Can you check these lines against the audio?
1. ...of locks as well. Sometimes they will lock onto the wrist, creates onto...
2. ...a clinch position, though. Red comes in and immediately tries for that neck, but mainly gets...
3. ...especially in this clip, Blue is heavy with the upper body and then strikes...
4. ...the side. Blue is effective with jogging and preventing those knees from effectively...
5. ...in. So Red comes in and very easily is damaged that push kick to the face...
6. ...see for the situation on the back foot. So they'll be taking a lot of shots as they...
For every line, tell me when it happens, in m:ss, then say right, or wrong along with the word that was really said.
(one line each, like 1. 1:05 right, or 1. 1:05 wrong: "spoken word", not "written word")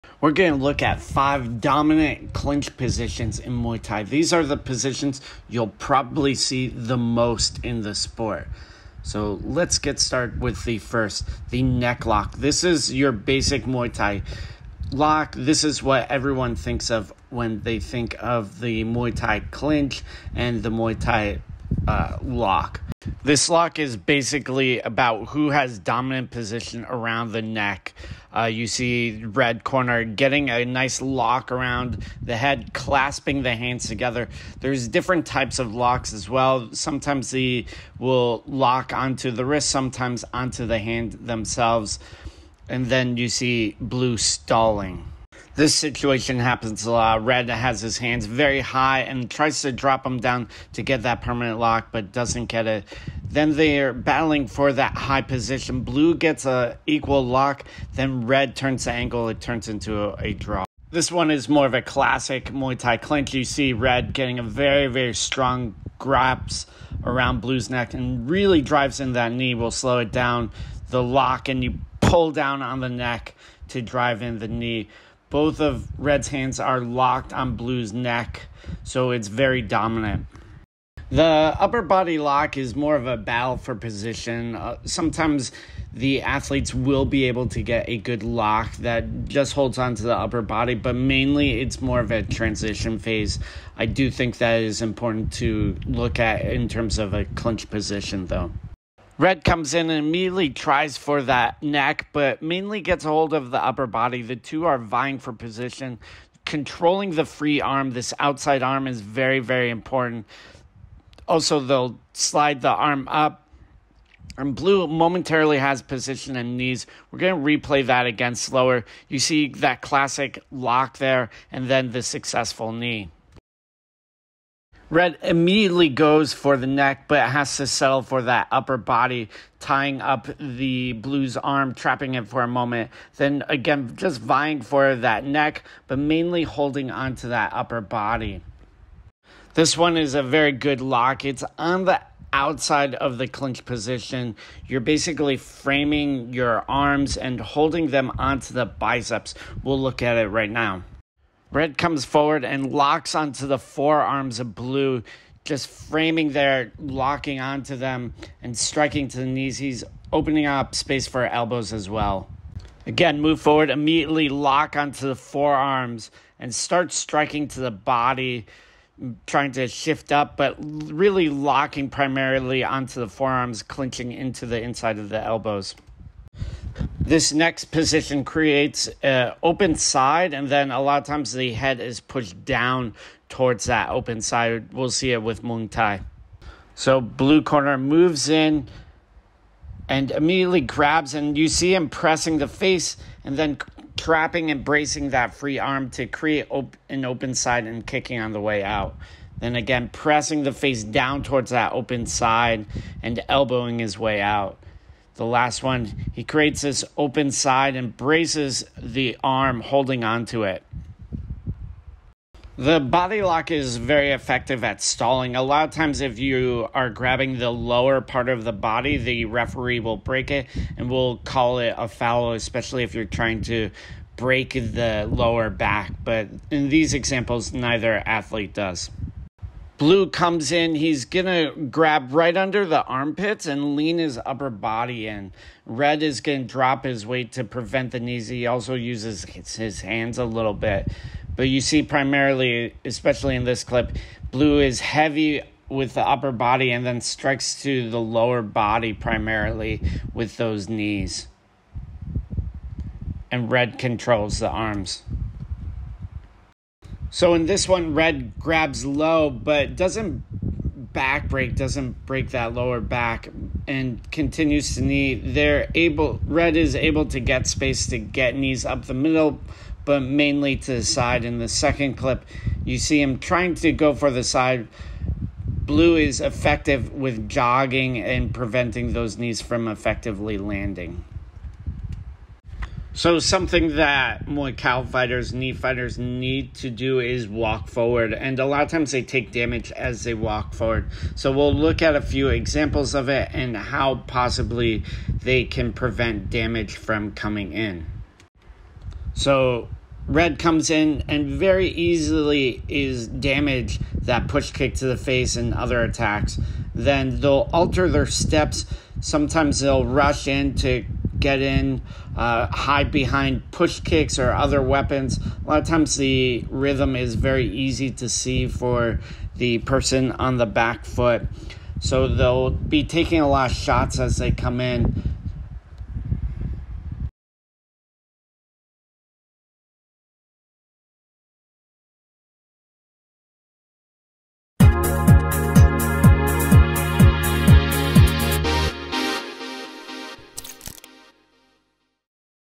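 1. 0:35 wrong: "sometimes", not "creates"
2. 1:37 right
3. 4:02 right
4. 4:34 right
5. 4:57 right
6. 5:18 wrong: "person", not "situation".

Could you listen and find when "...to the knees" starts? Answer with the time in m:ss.
2:39.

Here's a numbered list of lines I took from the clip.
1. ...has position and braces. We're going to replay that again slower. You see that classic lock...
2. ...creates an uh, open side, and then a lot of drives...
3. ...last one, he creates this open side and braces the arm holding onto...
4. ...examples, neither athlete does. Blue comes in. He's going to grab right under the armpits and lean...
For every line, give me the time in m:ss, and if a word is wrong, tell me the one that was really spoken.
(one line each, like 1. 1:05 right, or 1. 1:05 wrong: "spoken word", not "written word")
1. 1:55 wrong: "knees", not "braces"
2. 2:58 wrong: "times", not "drives"
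3. 3:25 right
4. 3:46 right.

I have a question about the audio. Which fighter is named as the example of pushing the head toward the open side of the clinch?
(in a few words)
Muangthai.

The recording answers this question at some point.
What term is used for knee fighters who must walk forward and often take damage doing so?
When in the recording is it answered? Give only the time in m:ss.
4:44.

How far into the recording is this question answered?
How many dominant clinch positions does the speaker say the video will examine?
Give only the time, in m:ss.
0:01.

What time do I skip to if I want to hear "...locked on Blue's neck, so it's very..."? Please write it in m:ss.
1:16.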